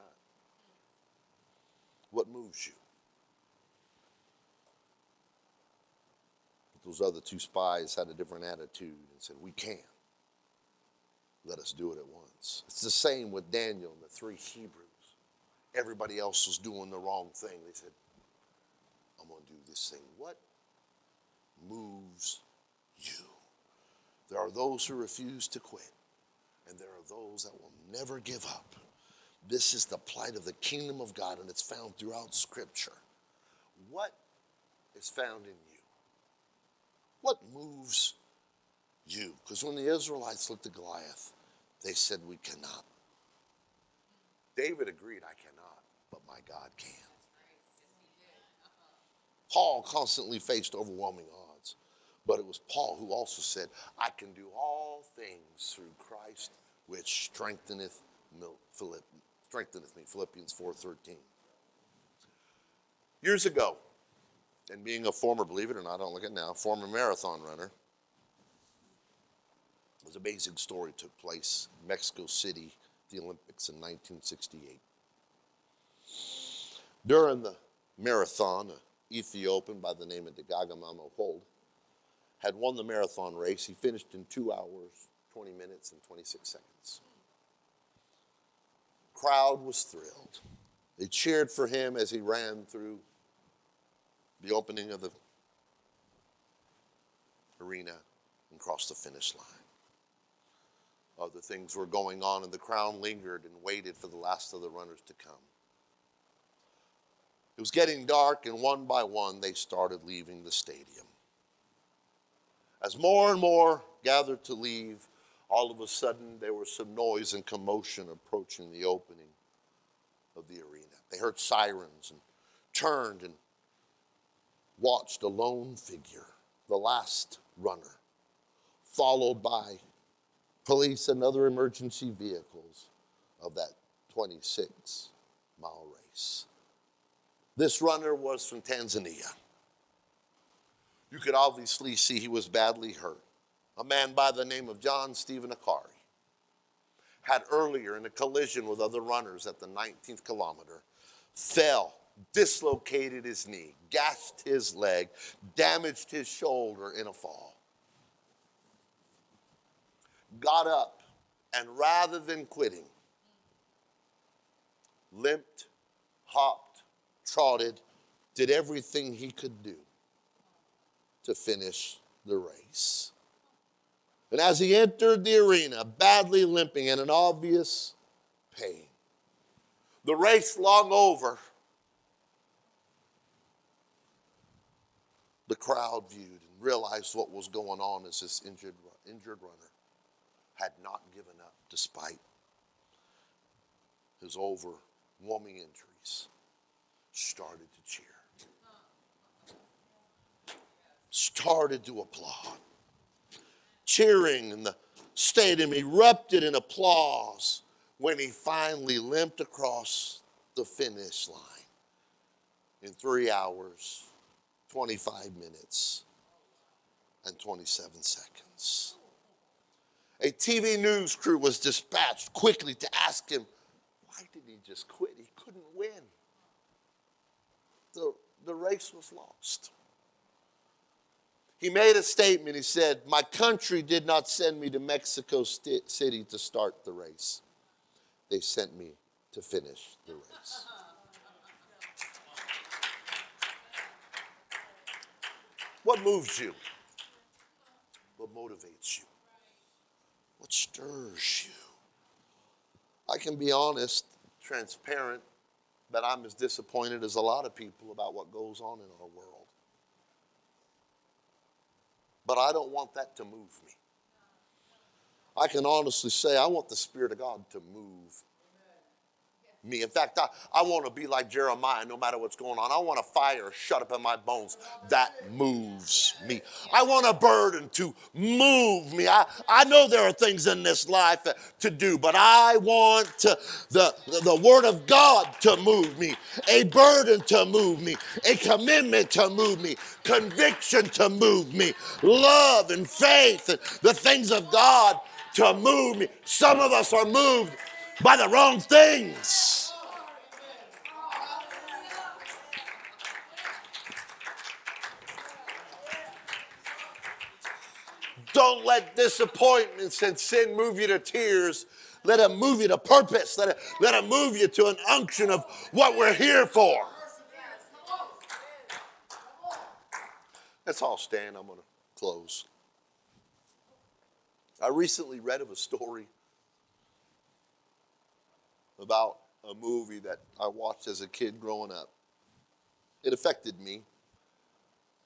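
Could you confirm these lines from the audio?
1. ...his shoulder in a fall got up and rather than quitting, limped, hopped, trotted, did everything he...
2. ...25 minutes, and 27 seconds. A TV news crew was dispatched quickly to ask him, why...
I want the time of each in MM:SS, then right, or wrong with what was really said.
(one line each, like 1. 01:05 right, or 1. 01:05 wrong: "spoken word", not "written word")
1. 02:36 right
2. 03:34 right.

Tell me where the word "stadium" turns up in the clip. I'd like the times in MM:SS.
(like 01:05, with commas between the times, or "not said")
01:50, 03:25.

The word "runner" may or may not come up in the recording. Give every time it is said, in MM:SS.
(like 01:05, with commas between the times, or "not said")
01:07, 01:44, 02:07, 02:17, 02:29, 03:09.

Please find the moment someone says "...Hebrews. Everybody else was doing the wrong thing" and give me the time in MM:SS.
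00:14.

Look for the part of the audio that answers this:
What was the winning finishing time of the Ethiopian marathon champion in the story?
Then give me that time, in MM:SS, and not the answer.
01:24.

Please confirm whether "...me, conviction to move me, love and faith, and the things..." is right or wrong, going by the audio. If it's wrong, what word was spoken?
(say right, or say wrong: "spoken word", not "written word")
right.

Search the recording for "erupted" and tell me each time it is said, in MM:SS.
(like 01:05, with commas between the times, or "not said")
03:25.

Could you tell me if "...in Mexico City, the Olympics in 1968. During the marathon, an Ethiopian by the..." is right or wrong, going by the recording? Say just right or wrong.
right.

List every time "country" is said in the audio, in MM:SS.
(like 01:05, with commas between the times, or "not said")
03:53.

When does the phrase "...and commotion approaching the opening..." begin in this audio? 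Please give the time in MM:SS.
01:57.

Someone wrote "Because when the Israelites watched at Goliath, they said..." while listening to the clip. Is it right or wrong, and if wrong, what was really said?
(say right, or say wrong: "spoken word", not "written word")
wrong: "looked", not "watched".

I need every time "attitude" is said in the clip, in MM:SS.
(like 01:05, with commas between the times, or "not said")
00:08.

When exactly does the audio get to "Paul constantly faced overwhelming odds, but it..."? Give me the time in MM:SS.
00:49.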